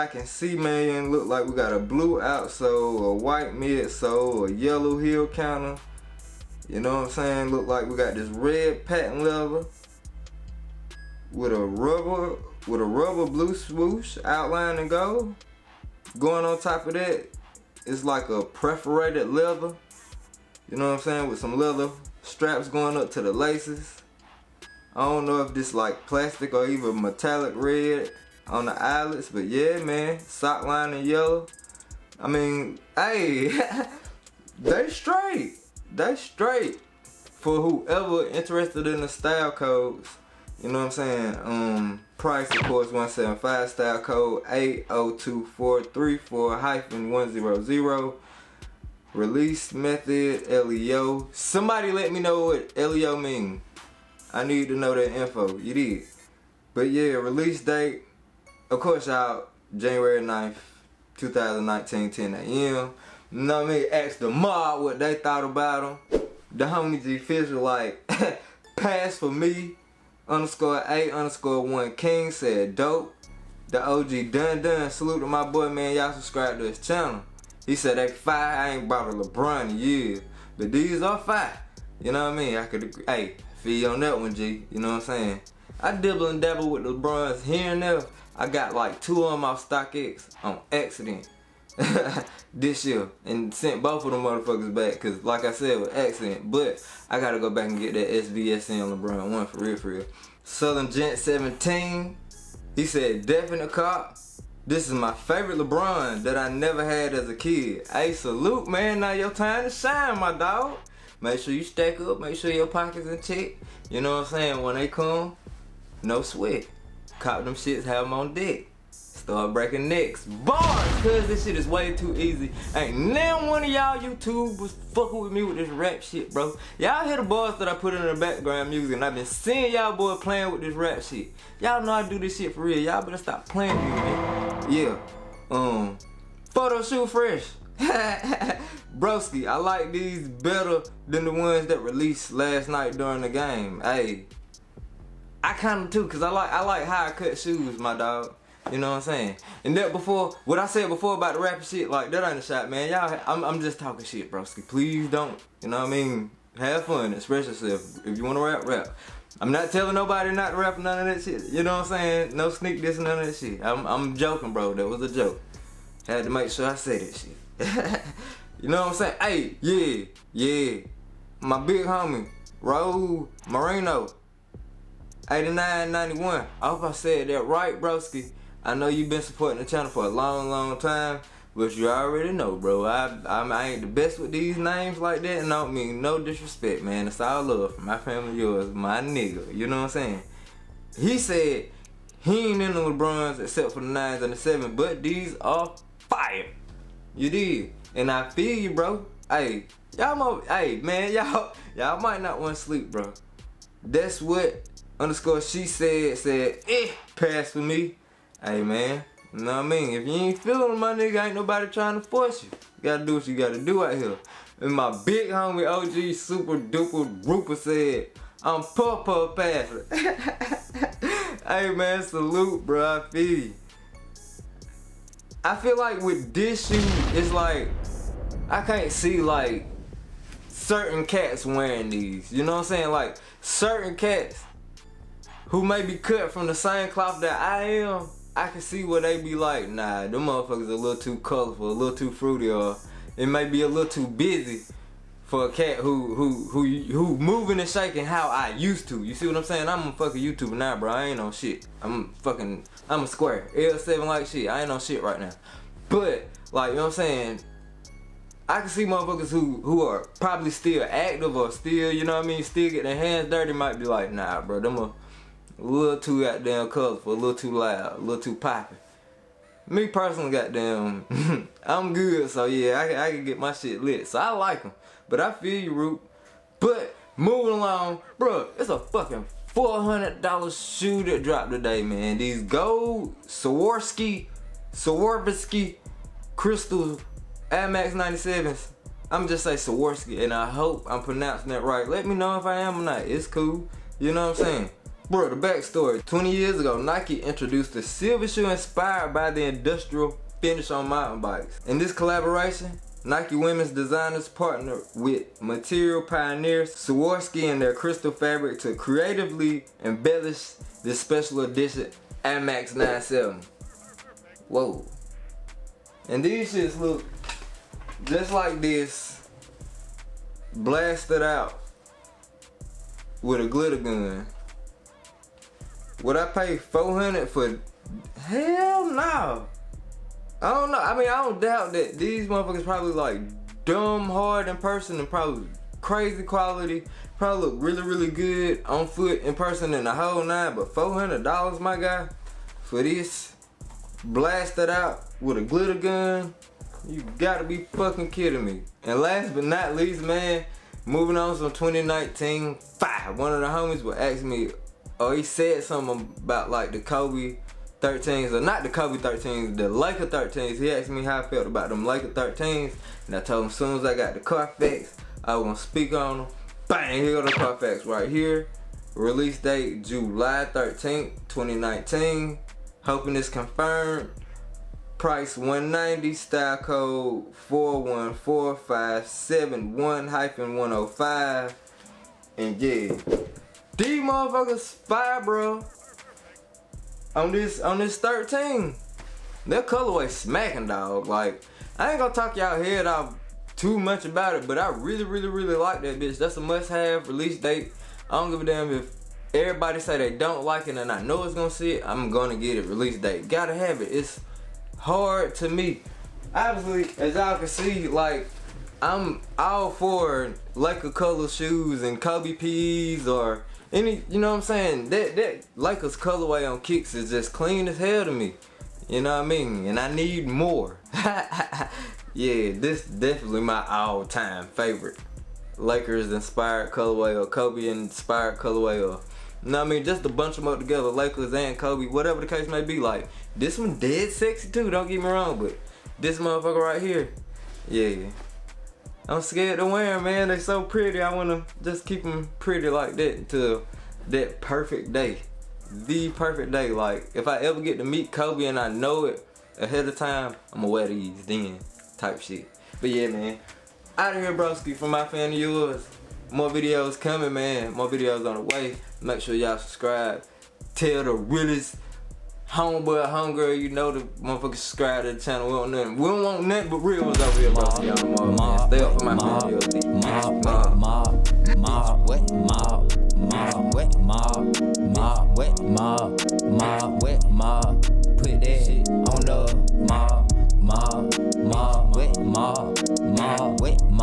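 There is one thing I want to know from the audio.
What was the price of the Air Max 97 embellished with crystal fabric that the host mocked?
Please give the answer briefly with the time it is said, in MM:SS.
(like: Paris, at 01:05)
$400, at 04:39.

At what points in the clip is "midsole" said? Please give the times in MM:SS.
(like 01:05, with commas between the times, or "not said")
00:03.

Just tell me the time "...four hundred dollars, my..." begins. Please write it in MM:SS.
05:40.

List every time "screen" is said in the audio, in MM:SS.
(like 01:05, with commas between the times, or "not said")
not said.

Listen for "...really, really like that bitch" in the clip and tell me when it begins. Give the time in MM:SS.
06:35.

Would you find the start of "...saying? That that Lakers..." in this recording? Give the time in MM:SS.
06:54.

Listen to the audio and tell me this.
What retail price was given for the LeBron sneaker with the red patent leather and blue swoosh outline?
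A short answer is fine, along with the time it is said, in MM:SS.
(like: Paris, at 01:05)
$175, at 00:42.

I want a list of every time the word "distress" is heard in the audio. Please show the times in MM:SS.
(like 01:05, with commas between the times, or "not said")
not said.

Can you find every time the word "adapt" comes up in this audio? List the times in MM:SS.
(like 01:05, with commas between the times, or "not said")
not said.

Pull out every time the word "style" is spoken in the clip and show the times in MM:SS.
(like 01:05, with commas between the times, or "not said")
00:39, 00:43, 06:16.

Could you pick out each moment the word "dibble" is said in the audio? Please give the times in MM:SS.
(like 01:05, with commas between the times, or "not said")
01:25.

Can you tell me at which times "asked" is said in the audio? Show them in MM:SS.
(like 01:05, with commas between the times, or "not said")
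01:03, 06:00.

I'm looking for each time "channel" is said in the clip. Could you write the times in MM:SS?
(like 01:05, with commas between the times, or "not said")
01:16, 02:59, 07:45.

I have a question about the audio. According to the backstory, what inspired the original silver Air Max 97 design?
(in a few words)
Mountain bikes.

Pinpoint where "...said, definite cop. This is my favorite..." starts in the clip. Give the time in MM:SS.
01:42.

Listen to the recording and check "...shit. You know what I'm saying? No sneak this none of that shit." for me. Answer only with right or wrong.
right.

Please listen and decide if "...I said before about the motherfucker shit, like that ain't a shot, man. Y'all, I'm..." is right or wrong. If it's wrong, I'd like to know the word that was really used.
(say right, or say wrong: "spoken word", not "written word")
wrong: "rapper", not "motherfucker".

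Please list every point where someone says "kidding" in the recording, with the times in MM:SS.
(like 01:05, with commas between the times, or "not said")
05:48.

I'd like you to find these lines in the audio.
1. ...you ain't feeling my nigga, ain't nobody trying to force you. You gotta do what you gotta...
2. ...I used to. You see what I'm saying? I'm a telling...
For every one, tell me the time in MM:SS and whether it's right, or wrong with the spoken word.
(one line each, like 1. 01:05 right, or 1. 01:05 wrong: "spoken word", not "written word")
1. 03:30 right
2. 04:08 wrong: "fucking", not "telling".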